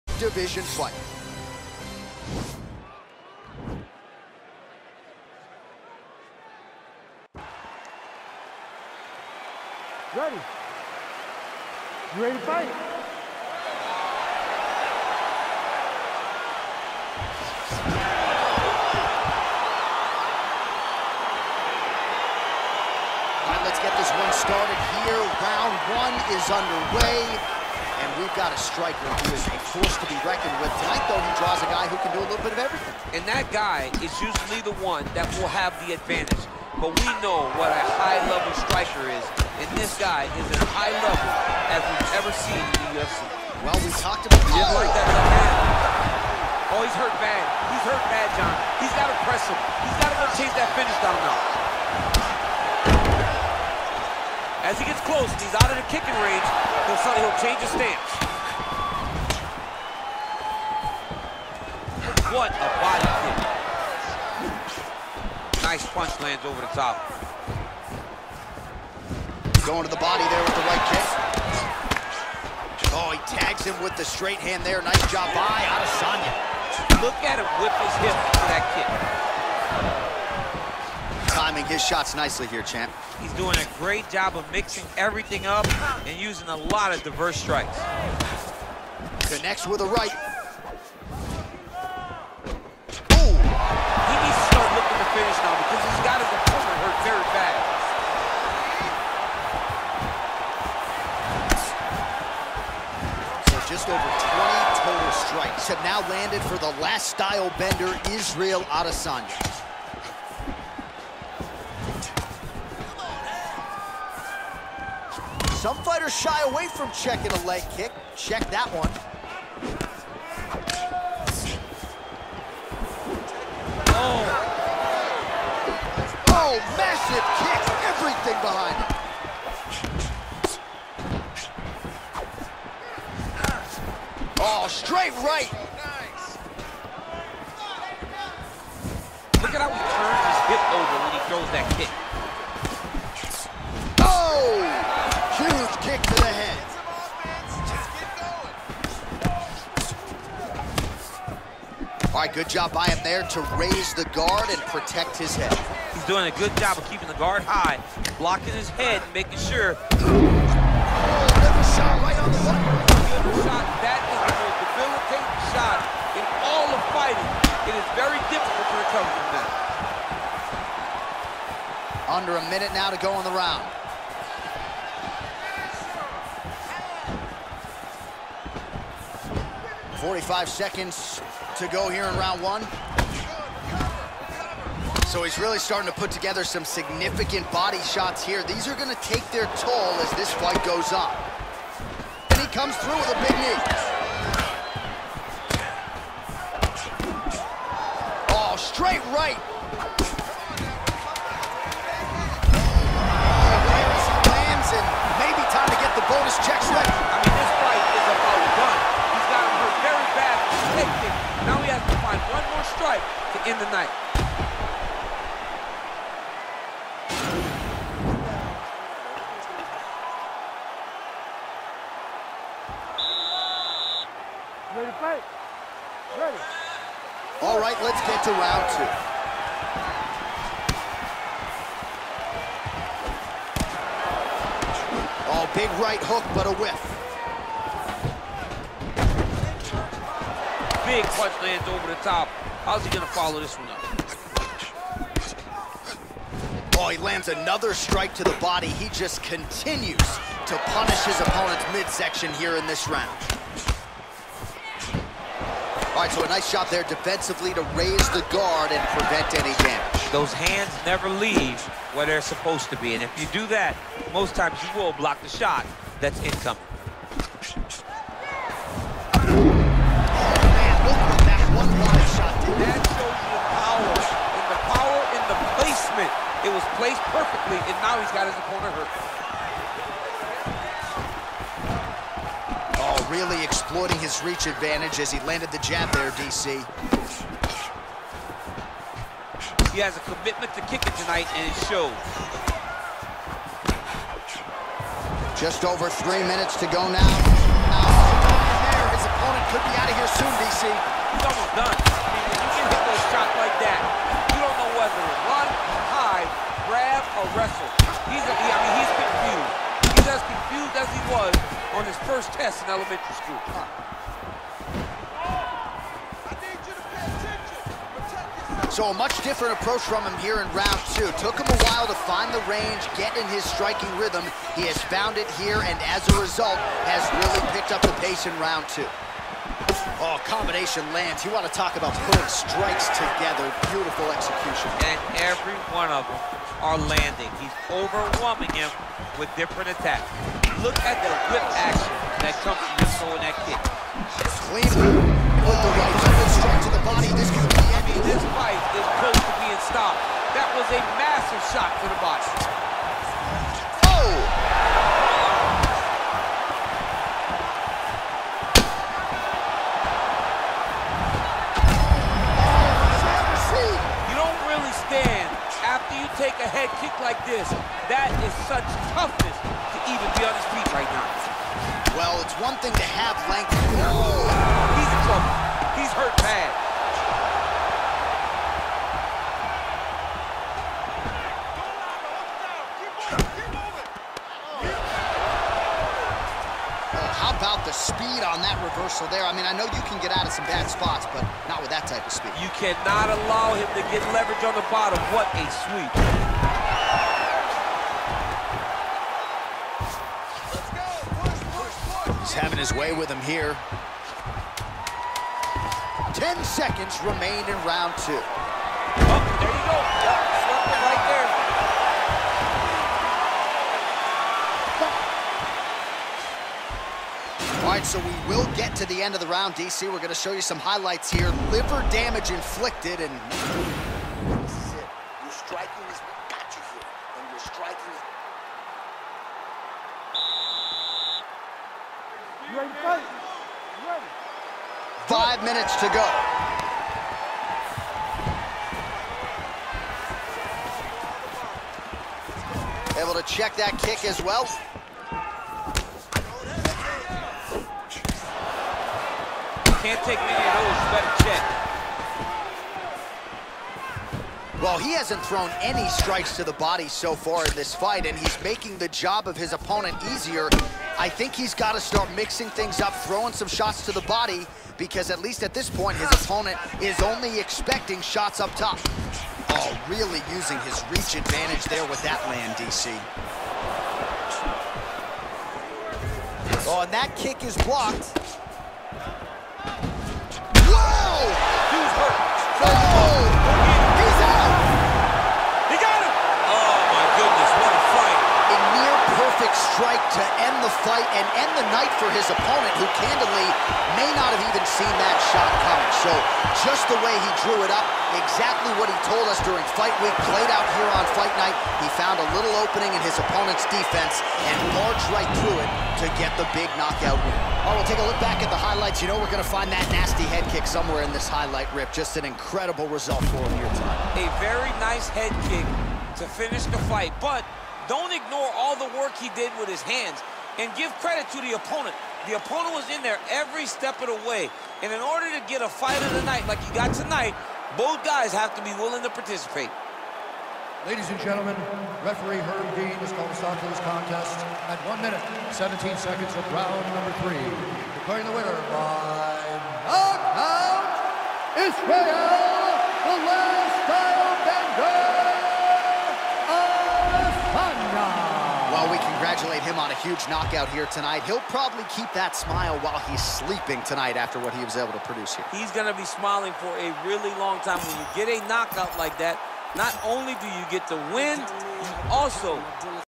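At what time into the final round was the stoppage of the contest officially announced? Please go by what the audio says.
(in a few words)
1 minute 17 seconds.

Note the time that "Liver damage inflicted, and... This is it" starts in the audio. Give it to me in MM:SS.
07:01.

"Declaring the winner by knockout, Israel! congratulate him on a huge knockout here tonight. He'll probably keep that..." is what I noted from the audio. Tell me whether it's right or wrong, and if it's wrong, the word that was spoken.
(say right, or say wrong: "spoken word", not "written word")
right.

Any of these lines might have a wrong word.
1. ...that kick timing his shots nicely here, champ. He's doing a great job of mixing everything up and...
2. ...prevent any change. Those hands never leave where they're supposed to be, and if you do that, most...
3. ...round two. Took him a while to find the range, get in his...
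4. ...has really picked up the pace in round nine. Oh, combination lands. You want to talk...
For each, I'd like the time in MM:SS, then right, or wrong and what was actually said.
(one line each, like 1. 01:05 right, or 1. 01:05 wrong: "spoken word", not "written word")
1. 01:18 right
2. 04:18 wrong: "damage", not "change"
3. 05:20 right
4. 05:26 wrong: "two", not "nine".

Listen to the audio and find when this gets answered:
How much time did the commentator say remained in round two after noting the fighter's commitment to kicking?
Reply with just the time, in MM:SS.
04:55.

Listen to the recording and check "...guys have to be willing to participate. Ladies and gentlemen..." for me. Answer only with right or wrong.
right.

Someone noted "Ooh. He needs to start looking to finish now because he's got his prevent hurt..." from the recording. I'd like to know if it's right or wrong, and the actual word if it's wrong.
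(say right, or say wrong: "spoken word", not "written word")
wrong: "opponent", not "prevent".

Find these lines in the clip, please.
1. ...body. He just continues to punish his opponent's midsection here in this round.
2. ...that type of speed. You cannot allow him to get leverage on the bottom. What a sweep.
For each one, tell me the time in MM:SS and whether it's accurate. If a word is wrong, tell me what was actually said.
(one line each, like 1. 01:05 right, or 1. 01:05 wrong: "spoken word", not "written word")
1. 04:08 right
2. 06:31 right.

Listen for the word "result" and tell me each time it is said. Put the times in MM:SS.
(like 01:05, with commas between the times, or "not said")
05:26, 08:32.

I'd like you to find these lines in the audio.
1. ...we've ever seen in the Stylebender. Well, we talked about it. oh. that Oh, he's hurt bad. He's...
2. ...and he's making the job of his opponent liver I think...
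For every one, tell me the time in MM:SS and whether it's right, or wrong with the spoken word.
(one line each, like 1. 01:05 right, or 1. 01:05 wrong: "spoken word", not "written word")
1. 00:41 wrong: "UFC", not "Stylebender"
2. 07:38 wrong: "easier", not "liver".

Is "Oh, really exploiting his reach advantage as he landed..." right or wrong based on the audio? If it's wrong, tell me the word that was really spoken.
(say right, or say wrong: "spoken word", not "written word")
right.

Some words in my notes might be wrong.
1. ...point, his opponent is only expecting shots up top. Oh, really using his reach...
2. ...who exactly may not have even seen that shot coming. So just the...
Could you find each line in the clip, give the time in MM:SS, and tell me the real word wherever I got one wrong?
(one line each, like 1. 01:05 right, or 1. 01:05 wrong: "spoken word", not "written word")
1. 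07:45 right
2. 08:12 wrong: "candidly", not "exactly".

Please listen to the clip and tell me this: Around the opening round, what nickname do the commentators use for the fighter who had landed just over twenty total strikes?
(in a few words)
The Last Stylebender.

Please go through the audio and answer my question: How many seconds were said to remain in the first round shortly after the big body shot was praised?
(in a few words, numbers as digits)
45.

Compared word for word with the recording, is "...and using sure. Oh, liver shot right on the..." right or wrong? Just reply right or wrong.
wrong.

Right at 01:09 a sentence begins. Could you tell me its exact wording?
Going to the body there with the right kick.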